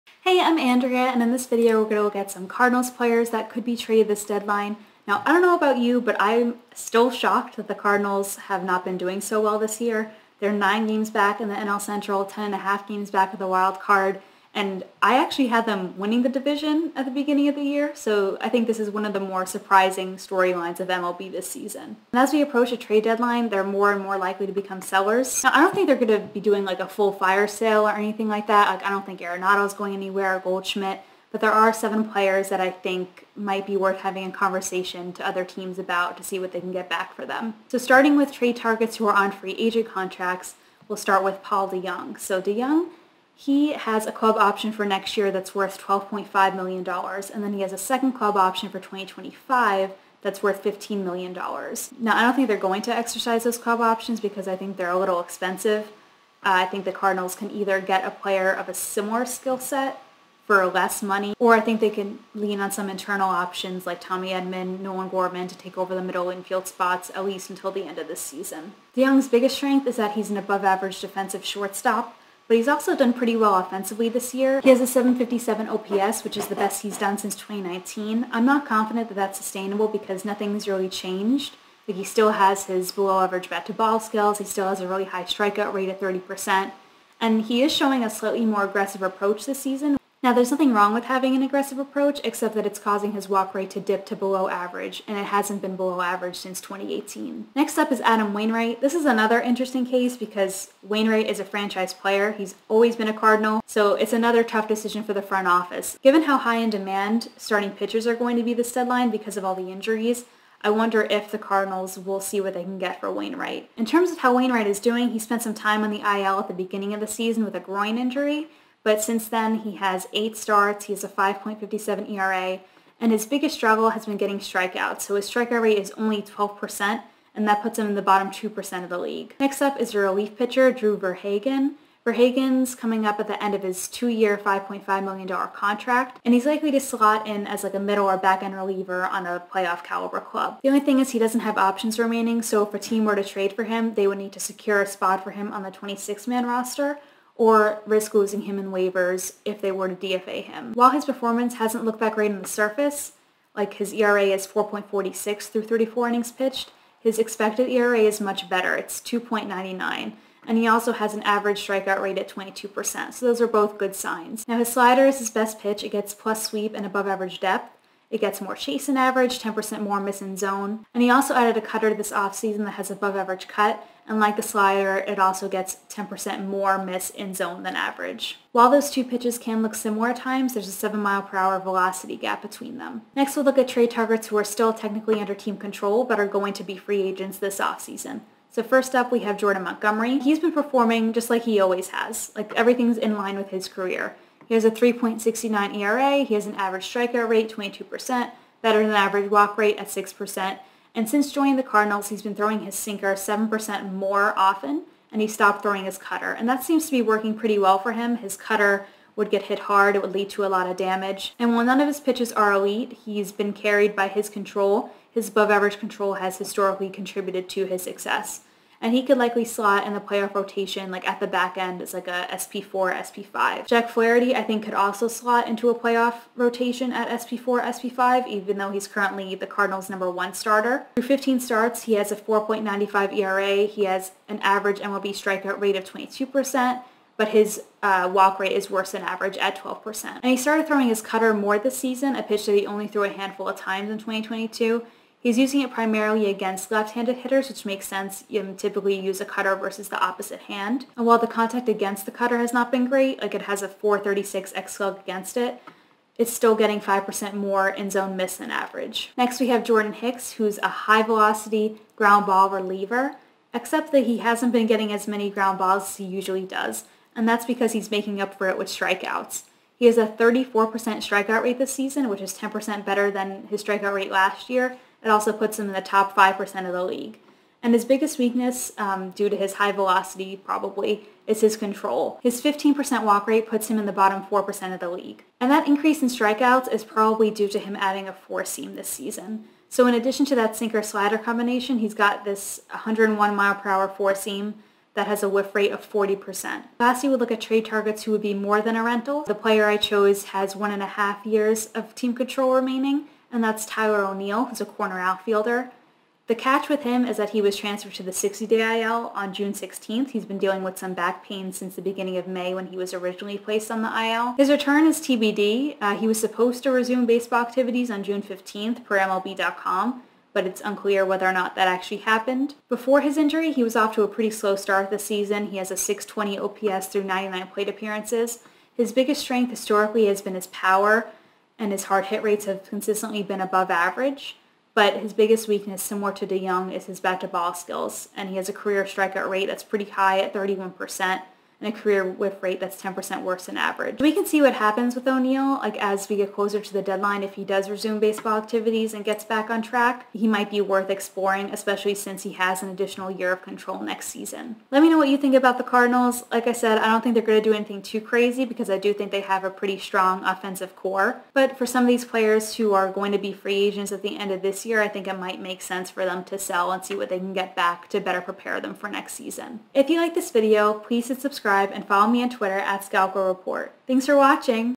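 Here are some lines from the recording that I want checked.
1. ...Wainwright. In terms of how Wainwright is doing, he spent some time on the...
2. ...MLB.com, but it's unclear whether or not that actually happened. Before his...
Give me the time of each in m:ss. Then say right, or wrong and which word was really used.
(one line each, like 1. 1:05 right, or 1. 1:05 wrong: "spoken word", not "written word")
1. 1:53 right
2. 5:18 right.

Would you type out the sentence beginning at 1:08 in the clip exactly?
DeJong's biggest strength is that he's an above average defensive shortstop, but he's also done pretty well offensively this year.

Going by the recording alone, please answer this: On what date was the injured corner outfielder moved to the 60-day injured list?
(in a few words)
June 16th.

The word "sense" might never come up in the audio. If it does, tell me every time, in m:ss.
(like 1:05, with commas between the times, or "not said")
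4:07, 6:05.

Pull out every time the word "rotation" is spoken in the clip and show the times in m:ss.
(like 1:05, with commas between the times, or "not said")
3:40, 3:46.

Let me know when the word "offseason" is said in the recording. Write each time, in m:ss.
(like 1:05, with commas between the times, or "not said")
2:52, 3:07.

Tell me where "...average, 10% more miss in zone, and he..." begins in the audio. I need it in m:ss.
2:48.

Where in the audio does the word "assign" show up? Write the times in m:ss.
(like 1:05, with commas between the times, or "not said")
not said.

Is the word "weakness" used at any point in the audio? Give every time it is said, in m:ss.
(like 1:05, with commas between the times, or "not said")
4:38, 5:35.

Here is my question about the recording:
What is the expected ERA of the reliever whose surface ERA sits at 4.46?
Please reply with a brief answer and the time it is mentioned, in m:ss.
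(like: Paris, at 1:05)
2.99, at 2:38.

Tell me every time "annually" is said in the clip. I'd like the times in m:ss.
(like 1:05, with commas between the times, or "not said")
not said.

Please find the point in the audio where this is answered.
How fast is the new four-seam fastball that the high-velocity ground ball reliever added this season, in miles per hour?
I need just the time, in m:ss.
4:52.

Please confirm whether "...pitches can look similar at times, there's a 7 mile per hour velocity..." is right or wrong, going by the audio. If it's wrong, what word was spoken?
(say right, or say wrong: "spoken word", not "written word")
right.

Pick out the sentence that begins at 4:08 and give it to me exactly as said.
You typically use a cutter versus the opposite hand.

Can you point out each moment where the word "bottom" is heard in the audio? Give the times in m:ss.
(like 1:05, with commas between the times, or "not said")
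2:08, 4:43.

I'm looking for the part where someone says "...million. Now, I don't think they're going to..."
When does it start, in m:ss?
0:51.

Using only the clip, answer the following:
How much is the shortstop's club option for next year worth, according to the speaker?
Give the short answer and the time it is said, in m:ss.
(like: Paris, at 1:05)
$12.5 million, at 0:45.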